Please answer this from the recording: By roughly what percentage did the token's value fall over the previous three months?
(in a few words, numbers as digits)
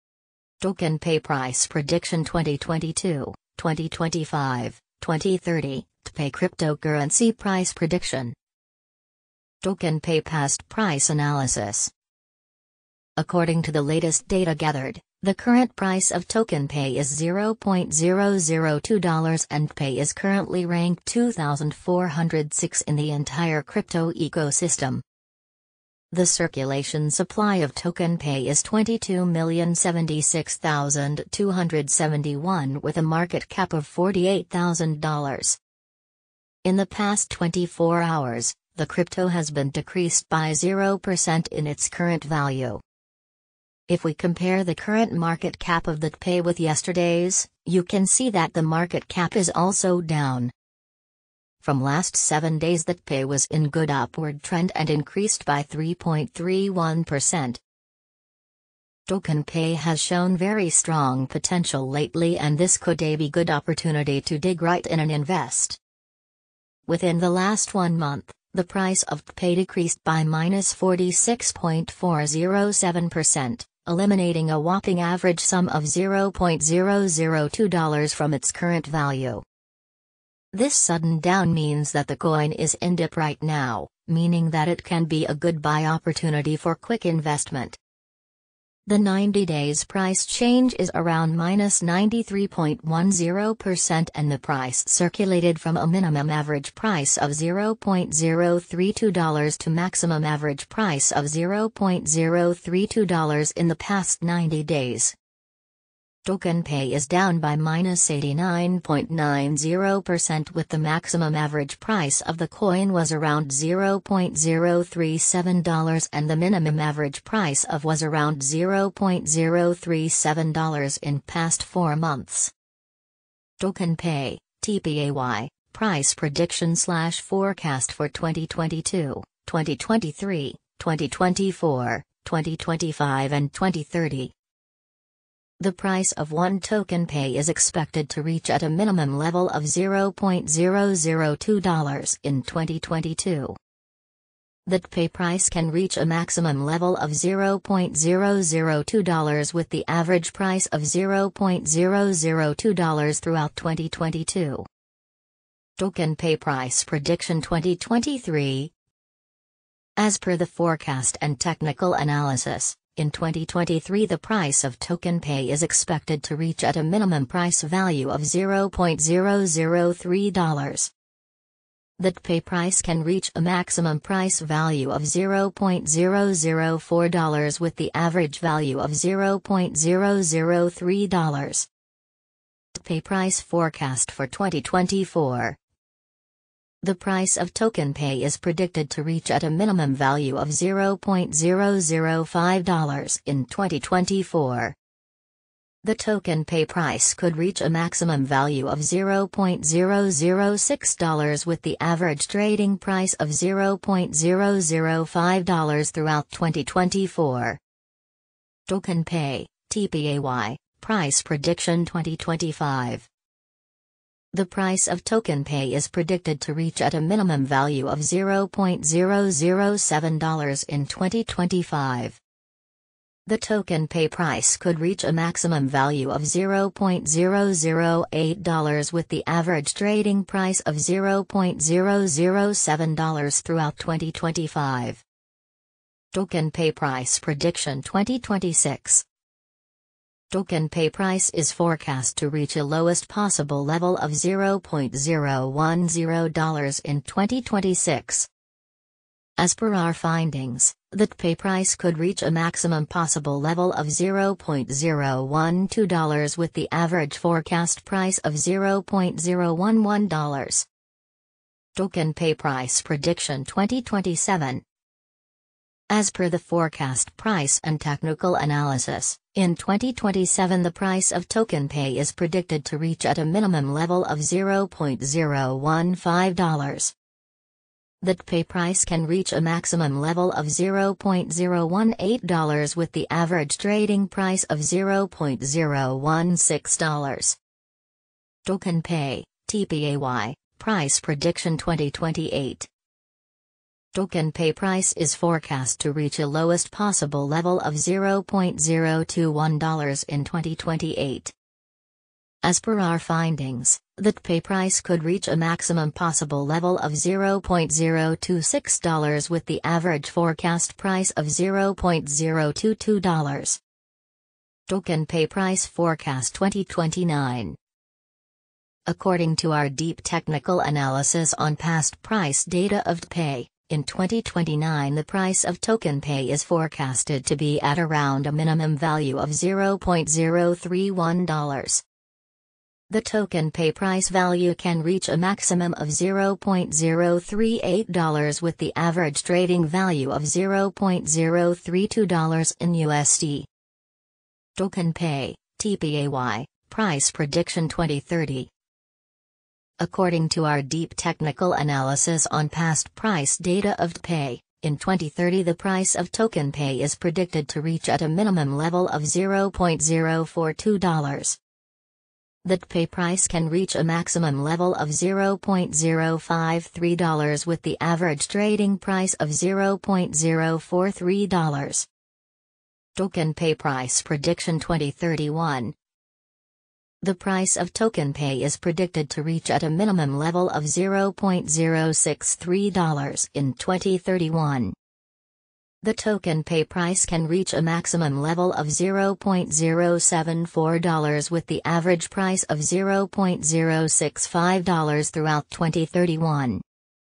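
93.10%.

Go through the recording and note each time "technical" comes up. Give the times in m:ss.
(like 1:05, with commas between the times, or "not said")
2:41, 4:27, 5:20, 5:50.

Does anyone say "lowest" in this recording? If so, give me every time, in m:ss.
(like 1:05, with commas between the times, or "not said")
4:02, 4:56.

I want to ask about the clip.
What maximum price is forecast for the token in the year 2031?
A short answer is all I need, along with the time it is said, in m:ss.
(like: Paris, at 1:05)
$0.074, at 6:28.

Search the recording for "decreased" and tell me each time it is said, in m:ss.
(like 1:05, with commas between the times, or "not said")
0:39, 1:09.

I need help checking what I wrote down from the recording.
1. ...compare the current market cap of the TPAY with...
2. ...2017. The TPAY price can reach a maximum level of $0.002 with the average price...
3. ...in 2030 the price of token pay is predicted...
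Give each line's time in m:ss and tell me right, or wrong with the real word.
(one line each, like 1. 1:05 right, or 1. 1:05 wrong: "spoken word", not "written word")
1. 0:44 right
2. 2:22 wrong: "2022", not "2017"
3. 5:54 right.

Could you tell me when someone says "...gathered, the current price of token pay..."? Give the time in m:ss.
0:14.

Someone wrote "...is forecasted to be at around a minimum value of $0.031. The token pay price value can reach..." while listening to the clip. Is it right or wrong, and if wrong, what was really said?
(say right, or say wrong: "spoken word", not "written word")
right.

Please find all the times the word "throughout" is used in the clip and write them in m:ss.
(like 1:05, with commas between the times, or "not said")
2:33, 3:25, 3:53, 6:35.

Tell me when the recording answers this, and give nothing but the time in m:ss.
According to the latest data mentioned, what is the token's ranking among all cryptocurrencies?
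0:21.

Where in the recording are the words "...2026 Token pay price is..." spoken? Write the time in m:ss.
3:57.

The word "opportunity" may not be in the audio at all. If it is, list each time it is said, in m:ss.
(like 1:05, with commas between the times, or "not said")
1:03, 1:25.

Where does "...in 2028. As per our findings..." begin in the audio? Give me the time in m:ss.
5:00.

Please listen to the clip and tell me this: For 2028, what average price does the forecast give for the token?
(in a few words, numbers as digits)
$0.022.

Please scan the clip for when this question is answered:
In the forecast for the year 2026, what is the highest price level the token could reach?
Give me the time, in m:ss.
4:13.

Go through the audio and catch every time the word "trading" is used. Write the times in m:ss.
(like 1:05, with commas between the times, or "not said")
3:22, 3:49, 4:43, 5:39, 6:08.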